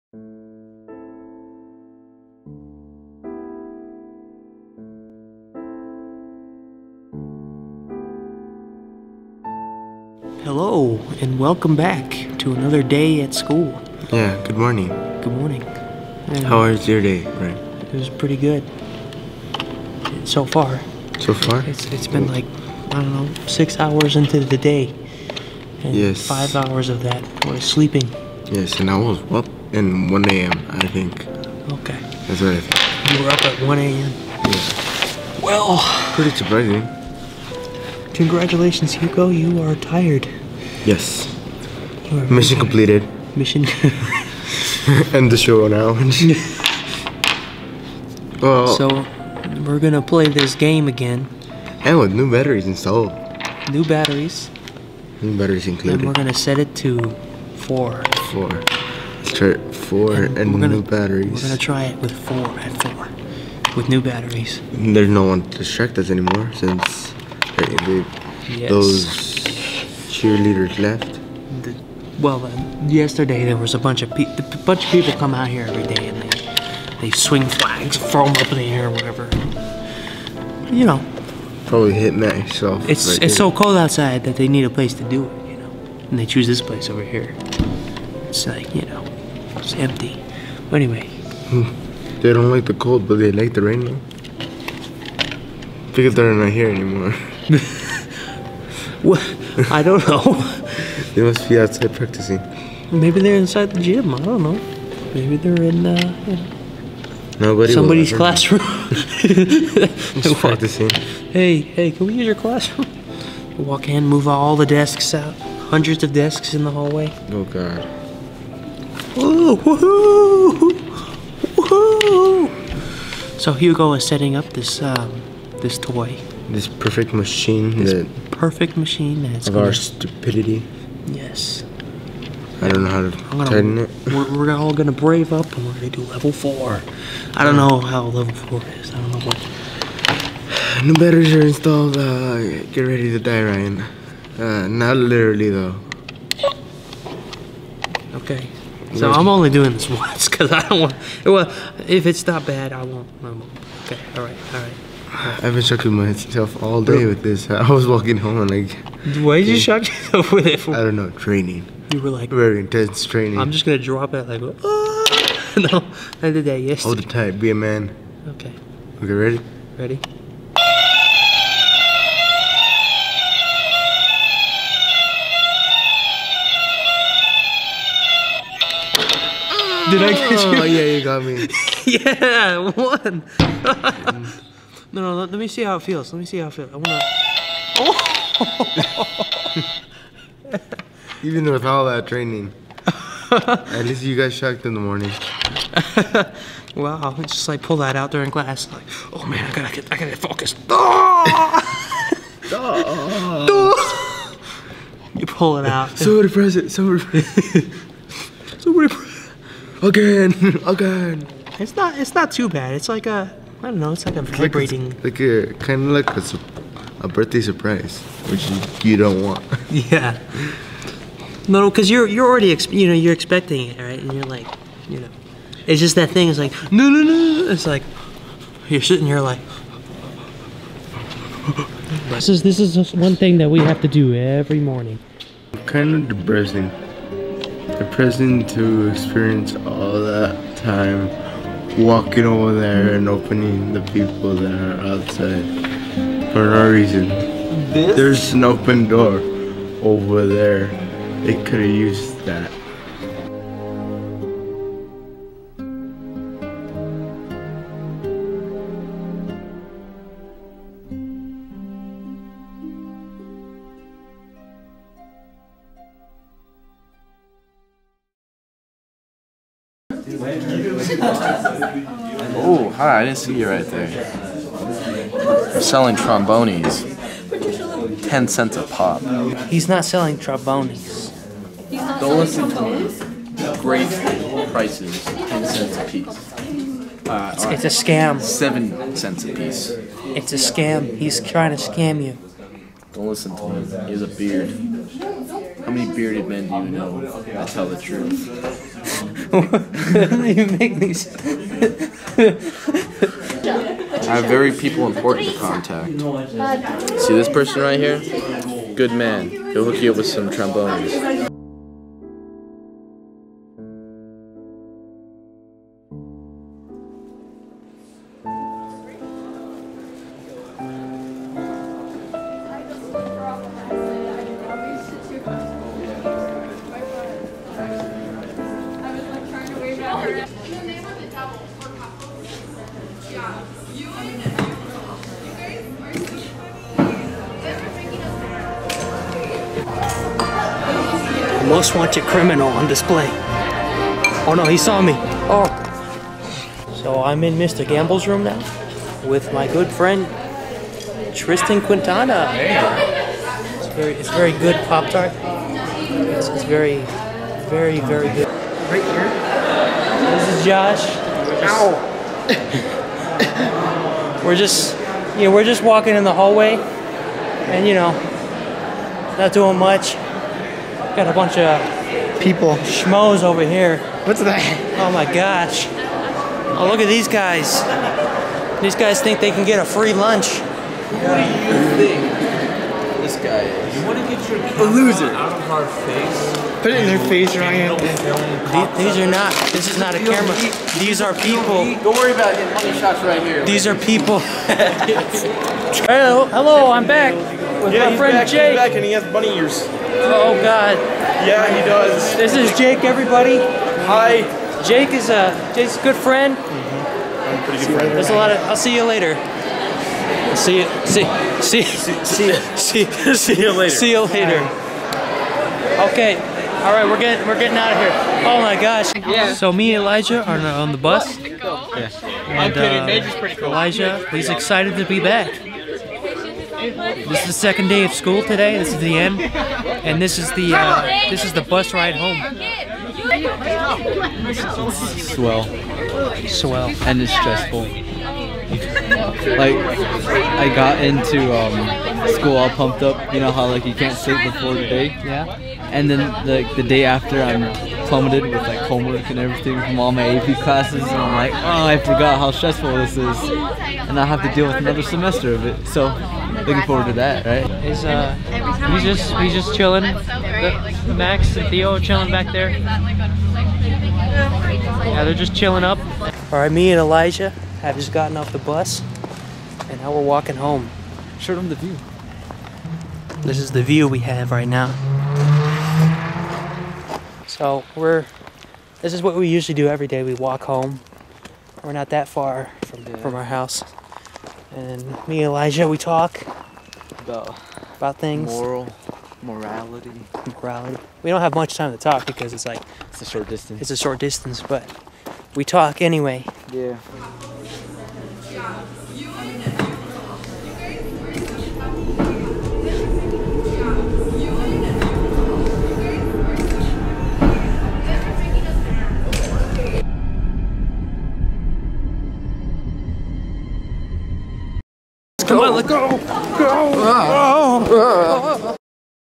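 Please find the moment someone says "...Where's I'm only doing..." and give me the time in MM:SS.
02:29.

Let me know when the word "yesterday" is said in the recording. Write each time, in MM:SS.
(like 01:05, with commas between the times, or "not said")
01:12, 02:46.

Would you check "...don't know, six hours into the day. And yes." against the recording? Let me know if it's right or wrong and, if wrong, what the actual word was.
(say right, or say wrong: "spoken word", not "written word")
right.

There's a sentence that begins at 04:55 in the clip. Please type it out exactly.
How many bearded men do you know that tell the truth?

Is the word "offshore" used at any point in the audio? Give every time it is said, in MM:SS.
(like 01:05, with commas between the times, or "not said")
not said.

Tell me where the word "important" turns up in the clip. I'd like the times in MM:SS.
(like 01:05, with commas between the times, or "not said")
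05:04.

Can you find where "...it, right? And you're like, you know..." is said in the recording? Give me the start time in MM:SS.
03:43.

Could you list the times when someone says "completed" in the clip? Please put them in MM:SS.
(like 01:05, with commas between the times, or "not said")
00:42.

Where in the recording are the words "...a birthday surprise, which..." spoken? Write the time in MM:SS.
03:37.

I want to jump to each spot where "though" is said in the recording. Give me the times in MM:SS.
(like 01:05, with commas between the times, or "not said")
01:33, 02:25.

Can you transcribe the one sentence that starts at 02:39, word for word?
Why did you shock yourself with it?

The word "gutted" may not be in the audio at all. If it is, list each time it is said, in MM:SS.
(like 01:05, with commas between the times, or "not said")
not said.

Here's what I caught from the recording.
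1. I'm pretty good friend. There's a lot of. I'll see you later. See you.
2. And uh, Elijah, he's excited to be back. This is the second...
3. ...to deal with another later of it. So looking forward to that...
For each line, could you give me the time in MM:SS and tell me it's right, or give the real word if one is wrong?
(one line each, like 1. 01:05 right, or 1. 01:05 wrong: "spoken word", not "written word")
1. 06:46 right
2. 07:02 right
3. 07:34 wrong: "semester", not "later".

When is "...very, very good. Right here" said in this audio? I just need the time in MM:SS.
05:57.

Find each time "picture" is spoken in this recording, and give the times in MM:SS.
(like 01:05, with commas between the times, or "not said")
not said.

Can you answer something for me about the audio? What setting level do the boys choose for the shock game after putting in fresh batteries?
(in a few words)
4.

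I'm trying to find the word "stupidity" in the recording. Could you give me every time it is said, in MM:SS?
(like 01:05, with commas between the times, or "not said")
02:09.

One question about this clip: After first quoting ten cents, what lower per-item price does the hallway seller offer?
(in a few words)
7 cents.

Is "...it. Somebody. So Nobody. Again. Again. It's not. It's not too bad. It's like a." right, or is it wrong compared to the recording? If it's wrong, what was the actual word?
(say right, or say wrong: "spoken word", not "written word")
wrong: "Press", not "Nobody".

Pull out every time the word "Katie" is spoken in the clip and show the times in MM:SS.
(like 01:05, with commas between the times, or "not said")
not said.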